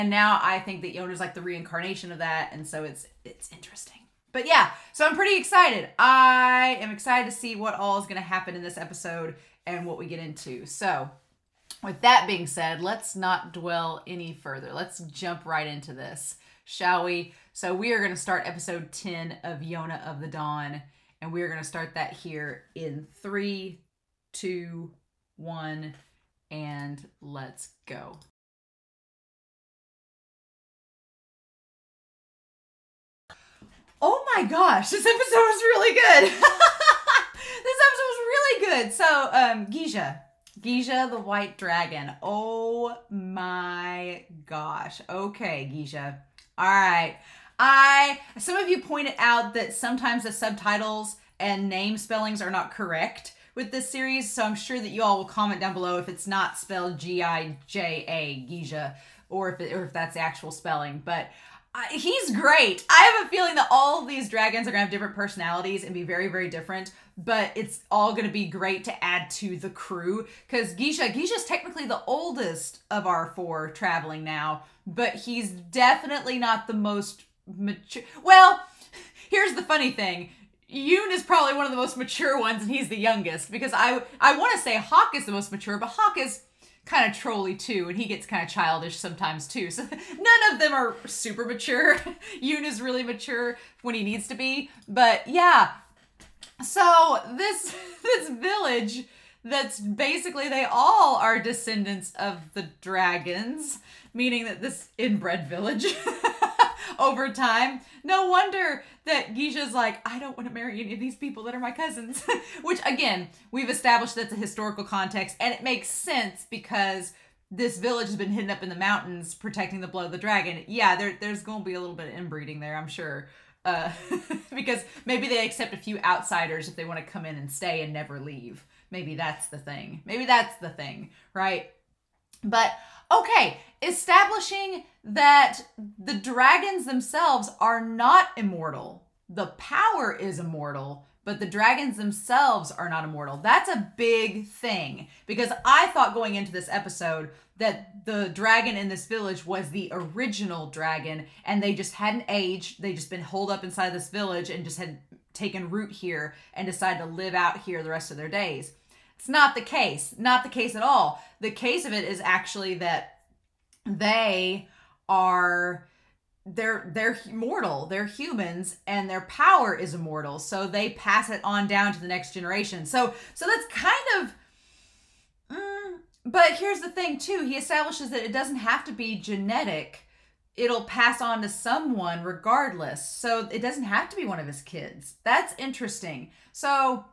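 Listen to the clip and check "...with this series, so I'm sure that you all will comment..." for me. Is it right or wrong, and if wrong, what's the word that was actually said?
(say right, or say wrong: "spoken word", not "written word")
right.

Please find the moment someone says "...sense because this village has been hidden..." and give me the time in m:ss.
1:55.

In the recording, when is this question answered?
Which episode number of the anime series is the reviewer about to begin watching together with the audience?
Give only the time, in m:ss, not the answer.
0:18.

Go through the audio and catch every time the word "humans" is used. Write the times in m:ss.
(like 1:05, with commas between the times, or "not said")
2:48.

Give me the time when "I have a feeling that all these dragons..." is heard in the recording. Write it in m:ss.
1:02.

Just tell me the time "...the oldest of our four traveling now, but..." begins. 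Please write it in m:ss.
1:11.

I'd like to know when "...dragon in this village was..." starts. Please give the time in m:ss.
2:28.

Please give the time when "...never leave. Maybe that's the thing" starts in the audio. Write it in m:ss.
2:07.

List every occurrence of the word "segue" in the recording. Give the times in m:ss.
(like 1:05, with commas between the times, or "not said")
not said.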